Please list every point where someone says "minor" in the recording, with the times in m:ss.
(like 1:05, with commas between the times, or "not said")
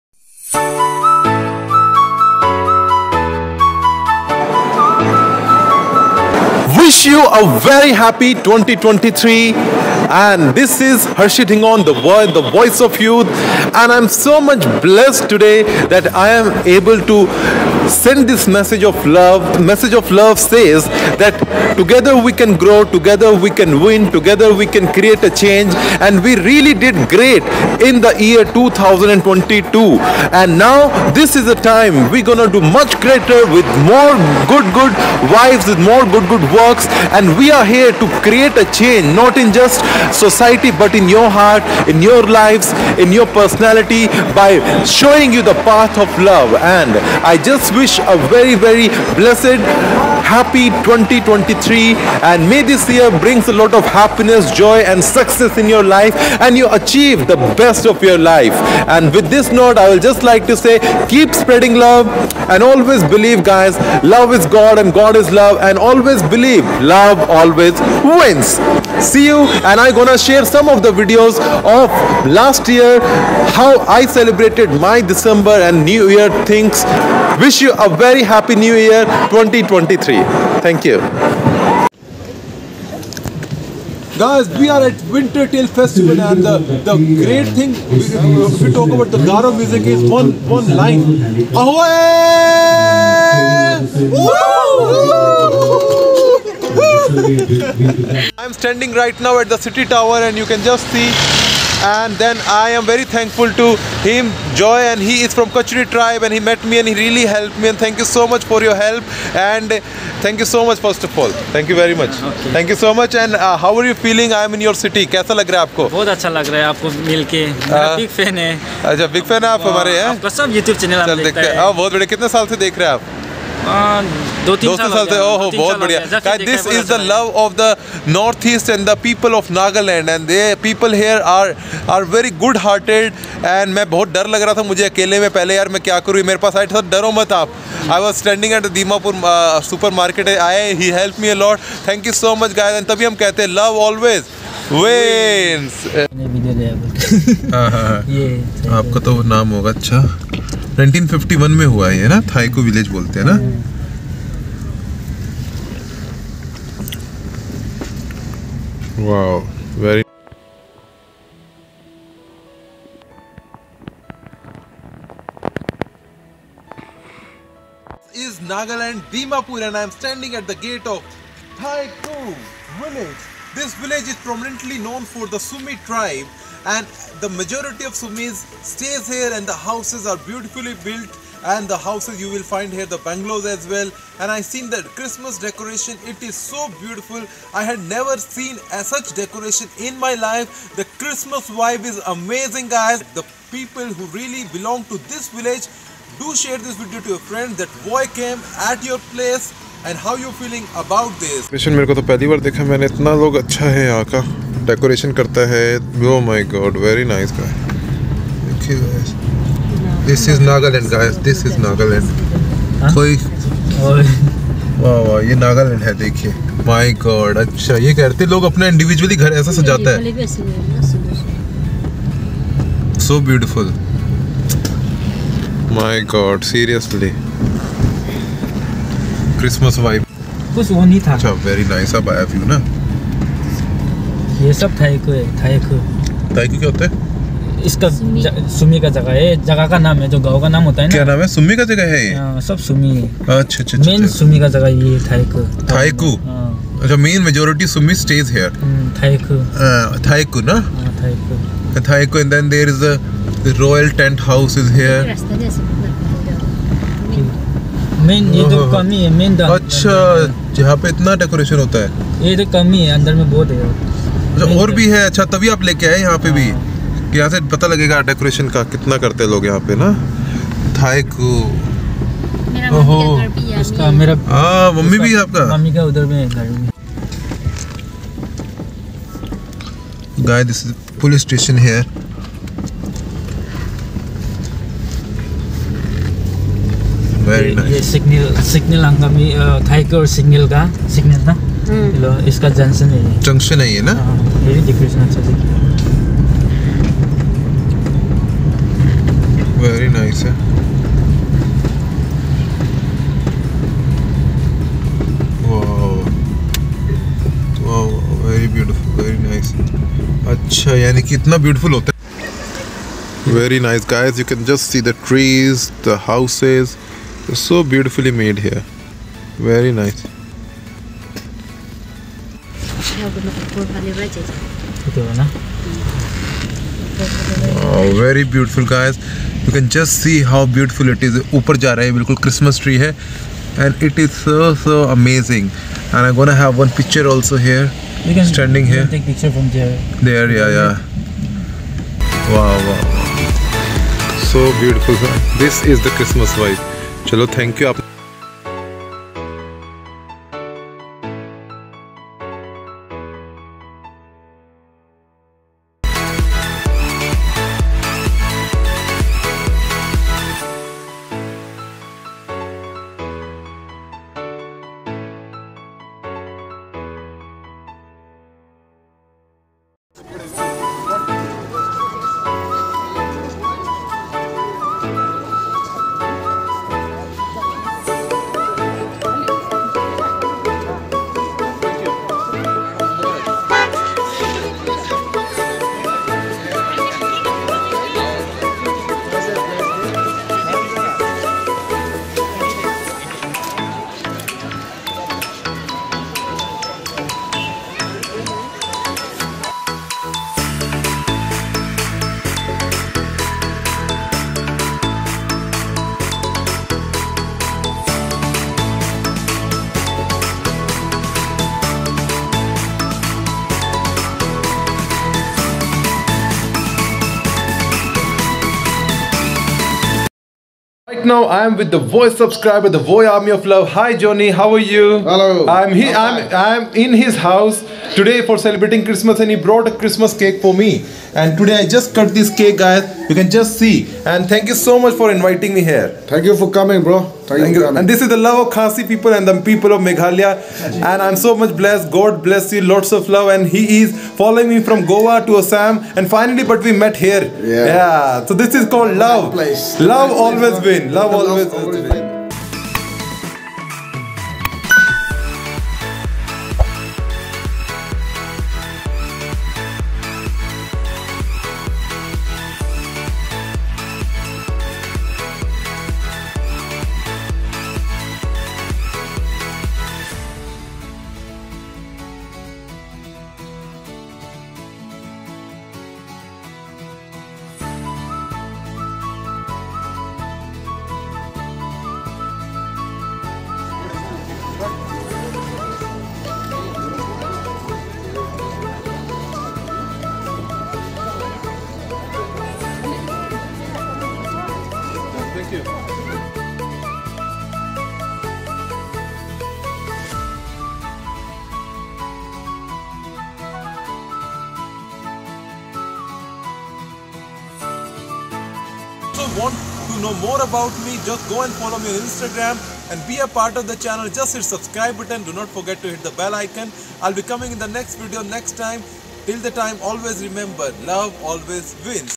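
not said.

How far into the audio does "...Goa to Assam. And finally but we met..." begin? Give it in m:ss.
7:24.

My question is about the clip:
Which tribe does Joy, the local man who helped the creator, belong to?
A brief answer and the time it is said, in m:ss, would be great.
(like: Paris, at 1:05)
Kachari, at 1:45.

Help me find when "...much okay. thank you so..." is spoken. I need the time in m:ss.
1:51.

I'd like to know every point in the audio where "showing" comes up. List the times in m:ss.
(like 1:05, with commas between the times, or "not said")
0:44.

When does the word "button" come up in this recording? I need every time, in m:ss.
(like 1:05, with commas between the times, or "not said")
8:34.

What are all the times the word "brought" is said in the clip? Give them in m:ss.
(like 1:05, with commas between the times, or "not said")
7:09.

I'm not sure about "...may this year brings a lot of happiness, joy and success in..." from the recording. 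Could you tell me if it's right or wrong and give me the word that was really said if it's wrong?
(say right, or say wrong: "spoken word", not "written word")
right.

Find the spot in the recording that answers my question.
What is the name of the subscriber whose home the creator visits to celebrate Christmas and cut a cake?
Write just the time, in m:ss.
7:03.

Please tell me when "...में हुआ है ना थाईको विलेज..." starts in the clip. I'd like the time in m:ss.
2:31.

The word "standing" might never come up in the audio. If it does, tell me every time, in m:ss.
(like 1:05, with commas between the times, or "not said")
1:38, 5:38.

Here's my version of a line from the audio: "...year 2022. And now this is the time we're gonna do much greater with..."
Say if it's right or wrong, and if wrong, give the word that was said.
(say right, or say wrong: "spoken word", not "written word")
right.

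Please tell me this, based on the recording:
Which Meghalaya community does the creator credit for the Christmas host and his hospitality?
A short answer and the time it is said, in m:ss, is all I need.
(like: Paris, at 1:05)
Khasi, at 7:18.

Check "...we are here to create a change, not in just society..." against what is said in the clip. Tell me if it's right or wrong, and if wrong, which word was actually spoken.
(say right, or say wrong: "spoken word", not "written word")
right.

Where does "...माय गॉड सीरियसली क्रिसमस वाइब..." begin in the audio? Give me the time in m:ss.
3:45.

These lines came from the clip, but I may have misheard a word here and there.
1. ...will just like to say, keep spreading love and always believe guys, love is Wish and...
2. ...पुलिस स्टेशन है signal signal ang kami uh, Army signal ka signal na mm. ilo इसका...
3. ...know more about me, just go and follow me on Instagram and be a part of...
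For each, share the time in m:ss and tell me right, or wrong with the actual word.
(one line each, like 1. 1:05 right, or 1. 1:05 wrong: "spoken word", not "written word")
1. 0:59 wrong: "God", not "Wish"
2. 4:41 wrong: "Tiger", not "Army"
3. 8:30 right.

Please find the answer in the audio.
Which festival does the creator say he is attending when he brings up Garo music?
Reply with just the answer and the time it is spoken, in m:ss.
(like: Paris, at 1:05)
Winter Tail Festival, at 1:25.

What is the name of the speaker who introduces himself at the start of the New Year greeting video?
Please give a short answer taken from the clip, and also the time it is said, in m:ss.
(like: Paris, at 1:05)
Harshit Dhingaun, at 0:11.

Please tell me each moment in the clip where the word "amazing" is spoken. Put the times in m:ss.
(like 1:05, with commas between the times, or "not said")
3:12, 5:34.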